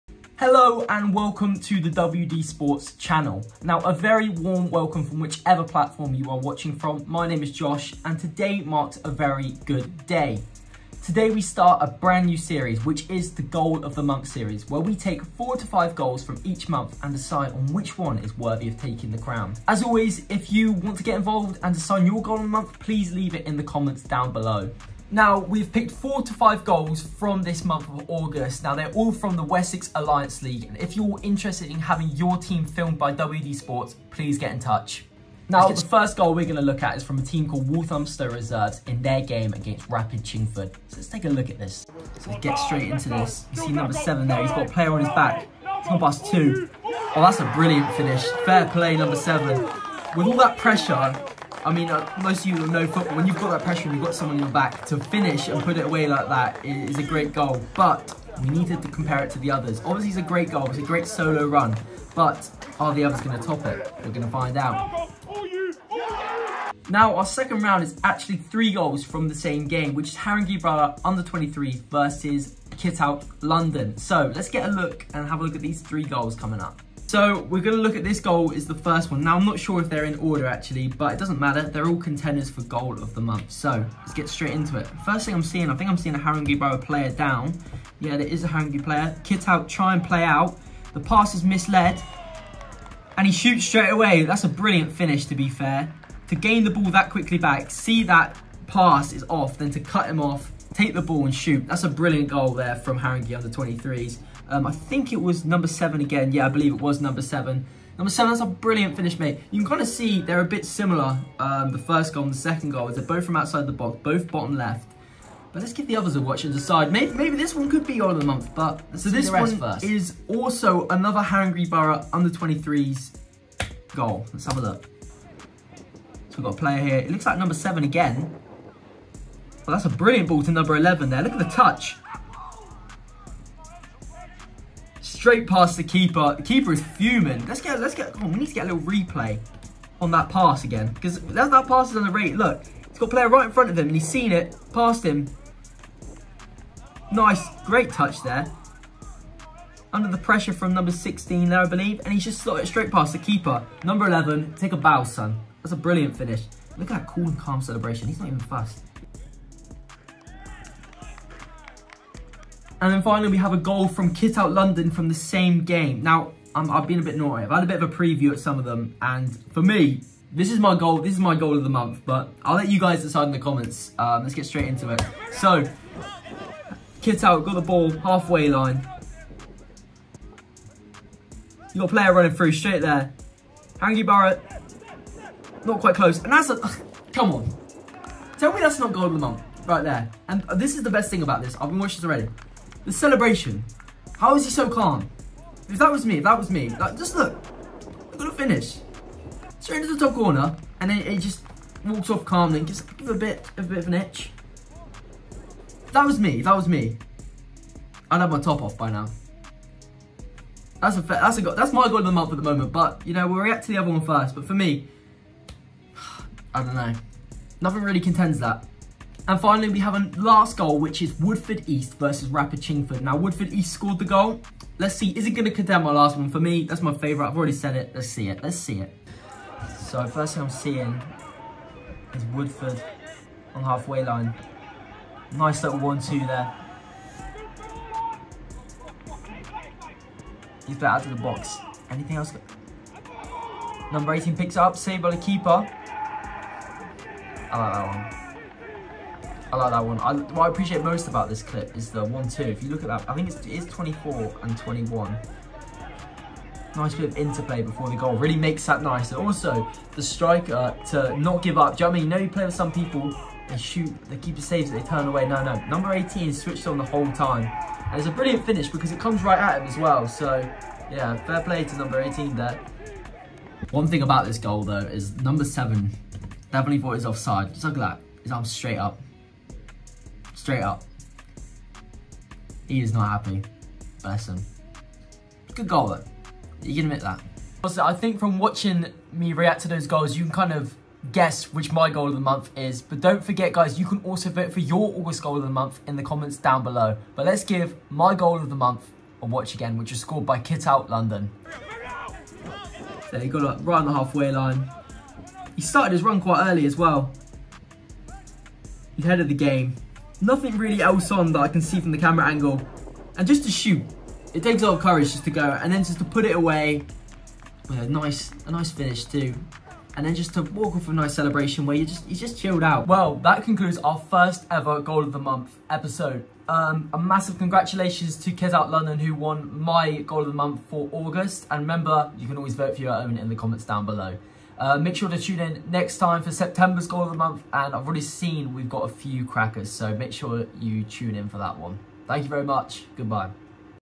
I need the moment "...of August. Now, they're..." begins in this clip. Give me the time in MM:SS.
00:27.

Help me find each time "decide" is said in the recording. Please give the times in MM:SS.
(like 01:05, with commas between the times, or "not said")
00:17, 01:56, 02:53.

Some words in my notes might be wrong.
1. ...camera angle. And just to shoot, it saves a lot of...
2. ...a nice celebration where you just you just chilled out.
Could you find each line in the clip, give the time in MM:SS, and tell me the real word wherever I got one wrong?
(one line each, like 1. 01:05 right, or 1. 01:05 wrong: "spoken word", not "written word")
1. 05:11 wrong: "takes", not "saves"
2. 05:20 right.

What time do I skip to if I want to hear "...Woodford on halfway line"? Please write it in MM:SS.
03:52.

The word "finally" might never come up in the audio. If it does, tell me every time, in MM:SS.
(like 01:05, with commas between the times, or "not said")
02:43, 03:39.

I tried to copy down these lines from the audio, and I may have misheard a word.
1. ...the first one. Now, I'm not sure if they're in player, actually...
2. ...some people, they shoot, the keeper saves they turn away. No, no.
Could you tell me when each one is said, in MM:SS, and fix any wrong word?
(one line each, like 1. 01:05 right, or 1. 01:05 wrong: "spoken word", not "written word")
1. 01:18 wrong: "order", not "player"
2. 04:22 right.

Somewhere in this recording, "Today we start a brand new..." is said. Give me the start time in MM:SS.
00:11.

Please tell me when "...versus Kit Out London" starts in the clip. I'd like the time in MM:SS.
01:11.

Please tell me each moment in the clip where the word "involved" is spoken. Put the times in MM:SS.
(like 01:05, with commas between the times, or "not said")
00:21.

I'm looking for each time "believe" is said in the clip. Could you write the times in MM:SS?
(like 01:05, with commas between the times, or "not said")
01:46, 02:31.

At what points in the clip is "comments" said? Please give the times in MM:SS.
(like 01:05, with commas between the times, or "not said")
00:23, 02:53, 04:56, 05:33.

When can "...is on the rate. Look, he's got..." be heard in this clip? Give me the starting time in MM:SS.
02:21.